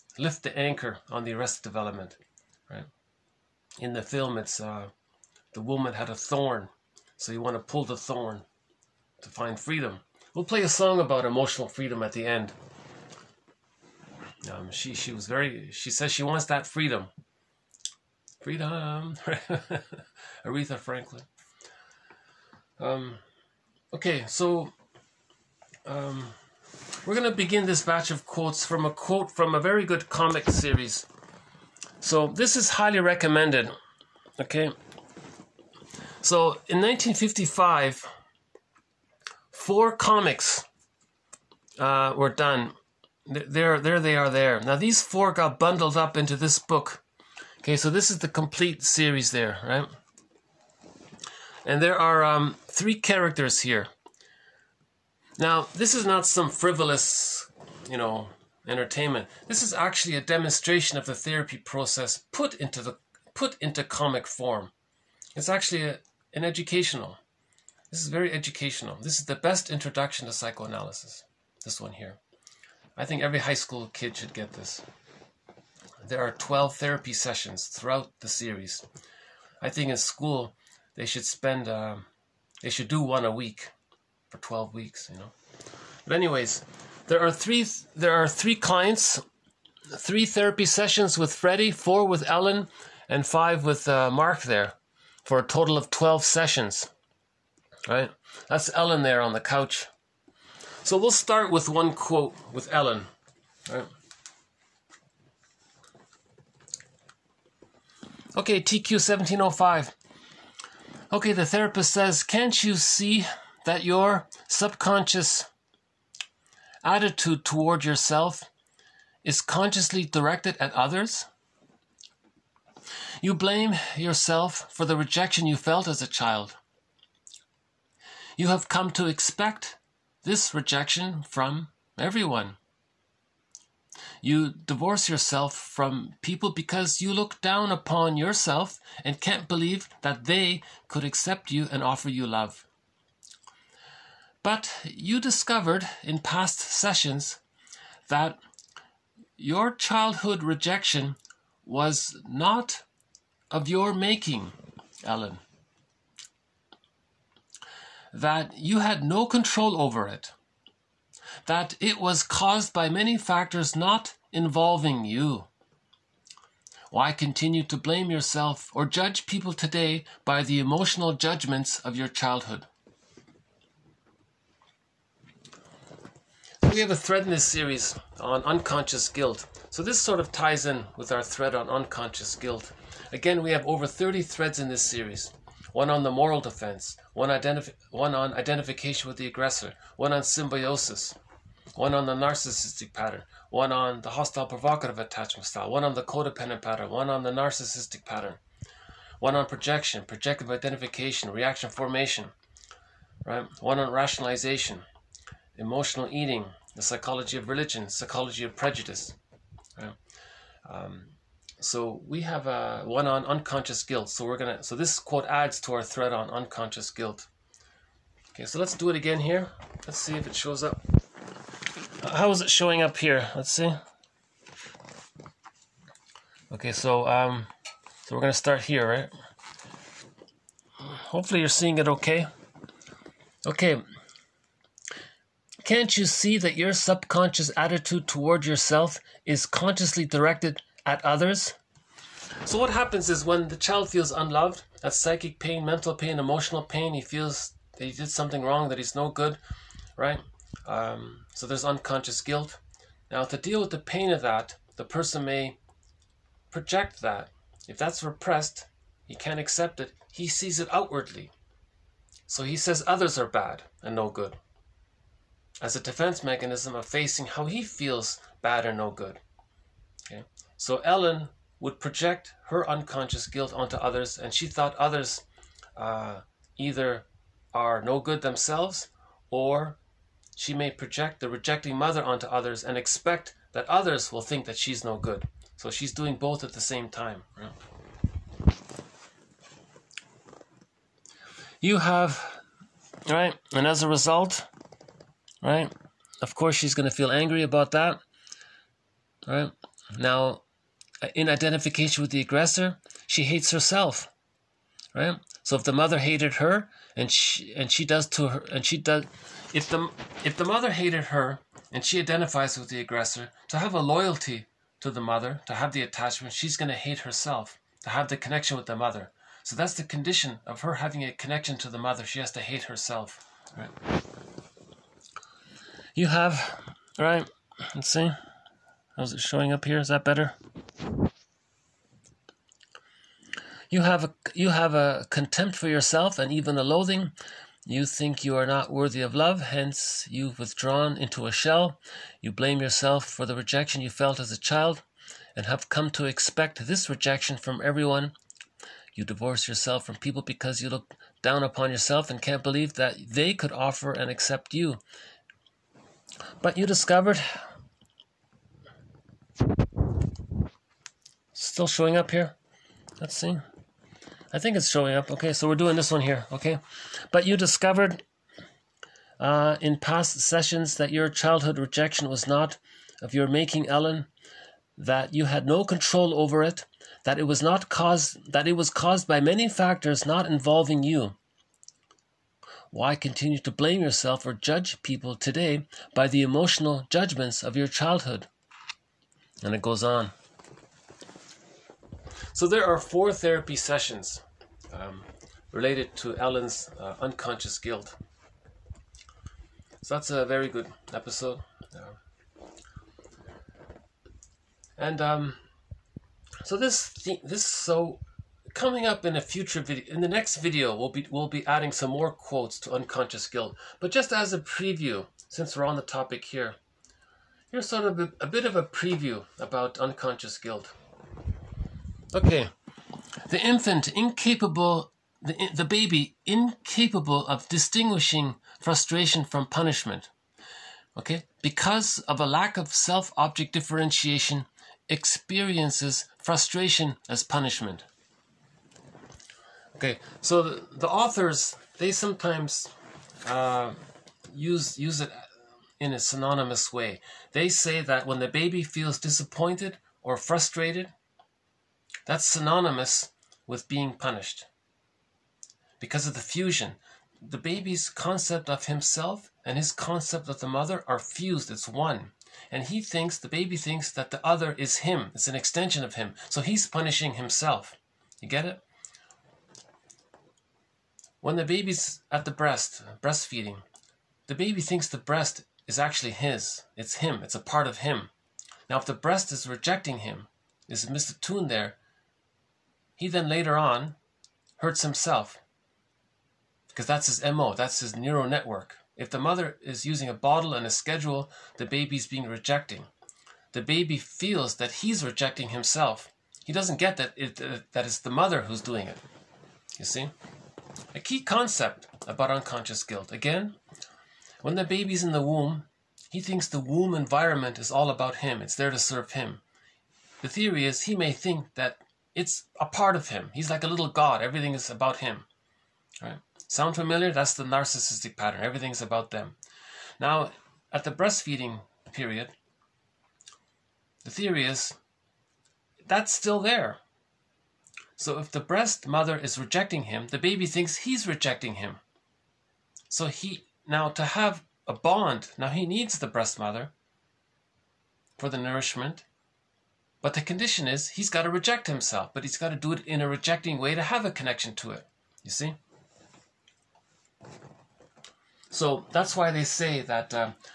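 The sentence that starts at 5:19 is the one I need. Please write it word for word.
So that's the condition of her having a connection to the mother.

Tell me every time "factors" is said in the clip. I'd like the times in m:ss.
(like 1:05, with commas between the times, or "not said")
2:43, 6:19.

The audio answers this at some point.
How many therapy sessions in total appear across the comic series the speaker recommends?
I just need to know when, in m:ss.
1:16.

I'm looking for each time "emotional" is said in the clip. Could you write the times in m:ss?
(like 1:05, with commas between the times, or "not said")
0:11, 2:50, 3:25, 4:06, 6:26.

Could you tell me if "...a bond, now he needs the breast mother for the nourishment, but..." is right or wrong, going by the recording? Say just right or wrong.
right.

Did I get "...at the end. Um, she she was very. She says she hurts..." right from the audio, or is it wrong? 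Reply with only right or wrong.
wrong.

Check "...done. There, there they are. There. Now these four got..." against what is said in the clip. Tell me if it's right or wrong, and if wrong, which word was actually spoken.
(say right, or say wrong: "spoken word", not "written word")
right.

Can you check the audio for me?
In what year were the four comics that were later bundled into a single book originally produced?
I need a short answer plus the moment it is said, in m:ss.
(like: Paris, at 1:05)
1955, at 0:36.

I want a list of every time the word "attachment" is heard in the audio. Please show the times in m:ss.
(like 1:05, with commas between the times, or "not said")
3:14, 5:15.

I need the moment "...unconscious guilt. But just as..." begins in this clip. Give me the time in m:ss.
6:52.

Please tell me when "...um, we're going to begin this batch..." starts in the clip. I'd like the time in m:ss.
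0:25.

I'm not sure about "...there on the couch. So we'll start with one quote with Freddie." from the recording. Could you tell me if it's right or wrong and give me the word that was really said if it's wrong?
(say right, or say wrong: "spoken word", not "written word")
wrong: "Ellen", not "Freddie".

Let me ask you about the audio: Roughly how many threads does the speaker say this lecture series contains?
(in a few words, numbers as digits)
over 30.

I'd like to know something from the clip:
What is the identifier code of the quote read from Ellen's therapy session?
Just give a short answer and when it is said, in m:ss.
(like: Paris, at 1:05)
TQ 1705, at 1:48.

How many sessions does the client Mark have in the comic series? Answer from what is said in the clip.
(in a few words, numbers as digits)
5.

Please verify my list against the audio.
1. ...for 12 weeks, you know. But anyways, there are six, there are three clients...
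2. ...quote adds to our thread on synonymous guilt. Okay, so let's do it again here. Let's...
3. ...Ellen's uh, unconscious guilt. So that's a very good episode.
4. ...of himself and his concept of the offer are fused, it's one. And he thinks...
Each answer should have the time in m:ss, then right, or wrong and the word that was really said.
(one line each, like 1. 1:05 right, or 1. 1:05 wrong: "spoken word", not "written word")
1. 1:24 wrong: "three", not "six"
2. 3:34 wrong: "unconscious", not "synonymous"
3. 6:36 right
4. 7:38 wrong: "mother", not "offer".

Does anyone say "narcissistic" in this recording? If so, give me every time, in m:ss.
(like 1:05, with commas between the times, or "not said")
3:12, 3:17, 8:37.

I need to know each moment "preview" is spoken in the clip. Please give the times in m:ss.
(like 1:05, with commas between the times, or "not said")
6:54, 6:58.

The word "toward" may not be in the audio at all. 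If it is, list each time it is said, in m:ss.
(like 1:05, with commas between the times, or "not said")
1:57, 3:58.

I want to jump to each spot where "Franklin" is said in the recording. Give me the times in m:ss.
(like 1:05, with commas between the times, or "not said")
0:20.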